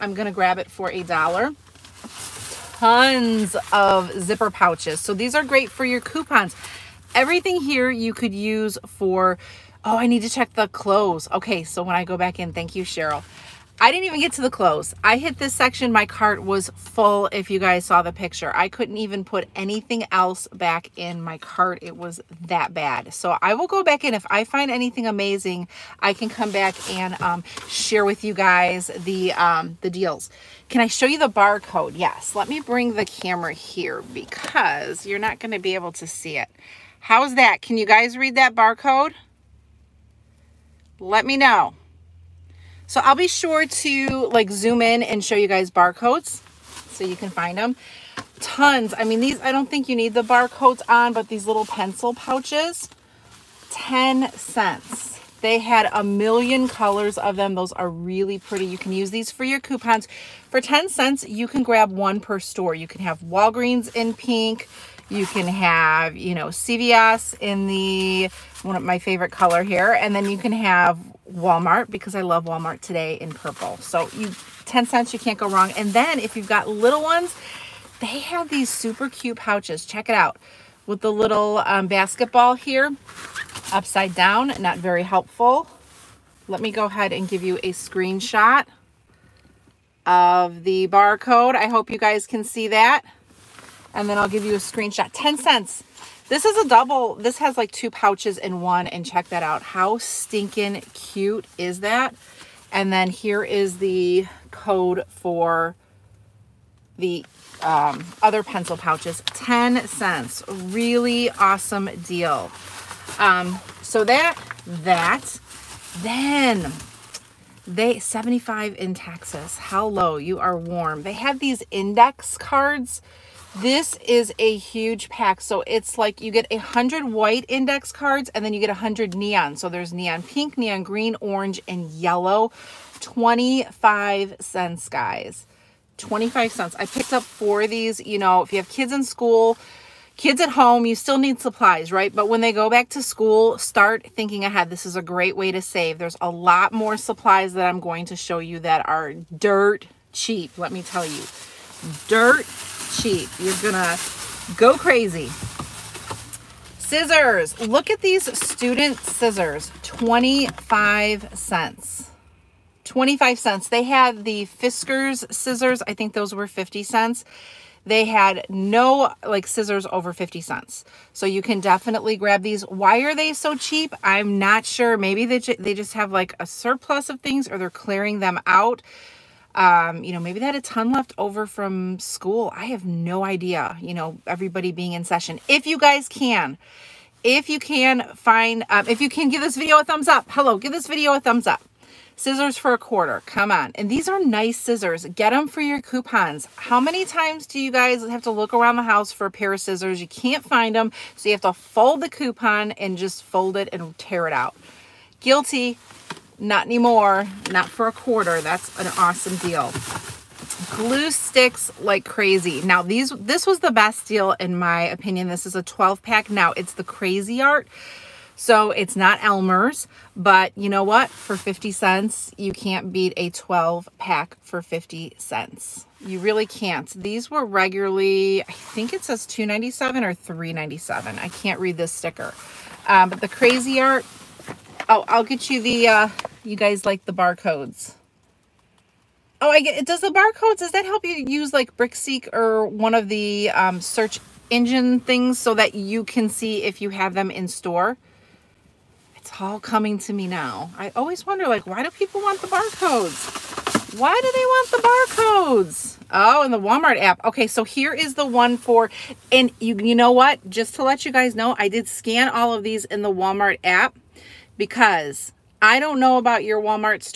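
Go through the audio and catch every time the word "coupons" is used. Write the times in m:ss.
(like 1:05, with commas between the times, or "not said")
0:05, 0:59, 3:15, 3:22.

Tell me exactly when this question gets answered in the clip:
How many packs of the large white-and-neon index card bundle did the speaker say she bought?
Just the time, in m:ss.
2:17.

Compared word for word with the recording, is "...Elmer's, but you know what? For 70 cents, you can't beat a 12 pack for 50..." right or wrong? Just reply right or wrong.
wrong.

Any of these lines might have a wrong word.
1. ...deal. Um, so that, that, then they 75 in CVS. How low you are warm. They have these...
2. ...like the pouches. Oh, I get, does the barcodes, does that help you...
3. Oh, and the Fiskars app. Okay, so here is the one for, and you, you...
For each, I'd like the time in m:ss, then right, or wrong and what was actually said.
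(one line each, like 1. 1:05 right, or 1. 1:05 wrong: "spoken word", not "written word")
1. 1:52 wrong: "Texas", not "CVS"
2. 3:56 wrong: "barcodes", not "pouches"
3. 4:16 wrong: "Walmart", not "Fiskars".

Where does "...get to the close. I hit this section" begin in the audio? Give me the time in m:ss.
0:14.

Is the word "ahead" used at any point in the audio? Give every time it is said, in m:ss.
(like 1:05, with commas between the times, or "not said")
1:26, 2:24.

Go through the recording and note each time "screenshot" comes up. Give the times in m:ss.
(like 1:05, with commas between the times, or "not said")
1:27, 1:34.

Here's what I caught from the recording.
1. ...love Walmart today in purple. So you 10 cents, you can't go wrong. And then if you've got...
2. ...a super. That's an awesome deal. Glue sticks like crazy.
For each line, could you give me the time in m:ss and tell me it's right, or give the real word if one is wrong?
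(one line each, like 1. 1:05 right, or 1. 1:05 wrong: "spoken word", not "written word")
1. 1:12 right
2. 3:27 wrong: "quarter", not "super".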